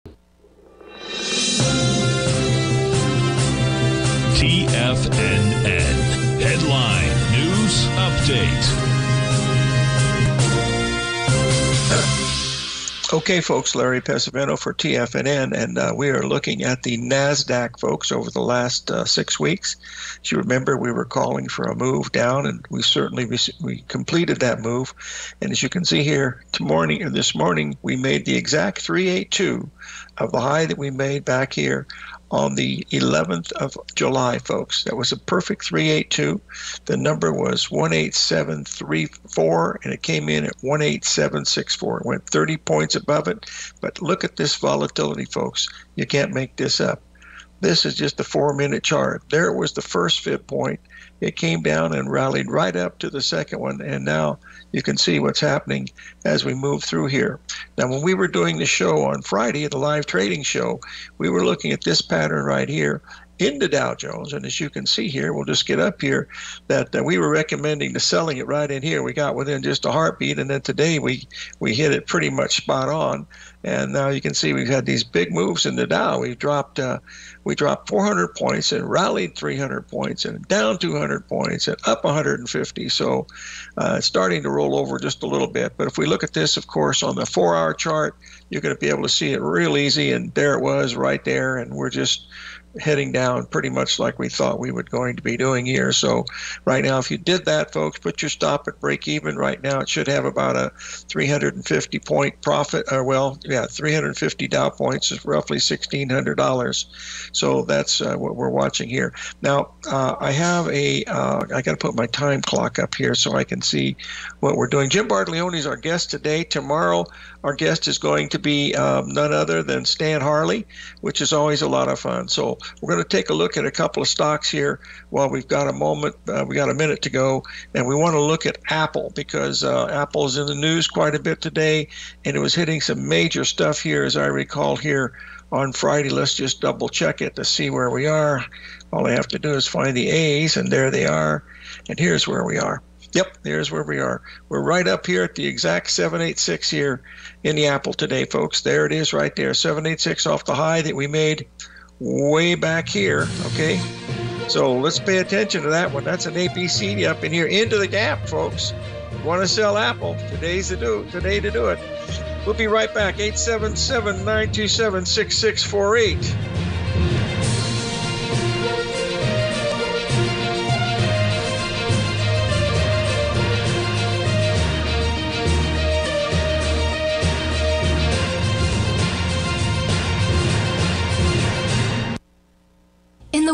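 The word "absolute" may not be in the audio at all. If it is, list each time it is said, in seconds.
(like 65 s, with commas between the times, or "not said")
not said.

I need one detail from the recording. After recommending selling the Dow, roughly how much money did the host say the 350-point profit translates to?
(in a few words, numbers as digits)
$1,600.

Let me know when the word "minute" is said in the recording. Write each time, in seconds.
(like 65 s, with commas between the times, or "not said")
48 s, 126 s.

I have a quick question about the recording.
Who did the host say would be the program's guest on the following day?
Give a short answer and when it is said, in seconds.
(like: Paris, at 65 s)
Stan Harley, at 119 s.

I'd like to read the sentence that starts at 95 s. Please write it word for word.
So right now, if you did that, folks, put your stop at break even right now.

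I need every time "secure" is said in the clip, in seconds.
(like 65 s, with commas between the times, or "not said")
not said.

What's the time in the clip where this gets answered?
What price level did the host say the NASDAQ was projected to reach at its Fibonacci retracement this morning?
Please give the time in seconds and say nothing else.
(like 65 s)
37 s.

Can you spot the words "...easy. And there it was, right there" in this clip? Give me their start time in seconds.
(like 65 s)
89 s.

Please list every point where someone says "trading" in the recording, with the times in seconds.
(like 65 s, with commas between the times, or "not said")
60 s.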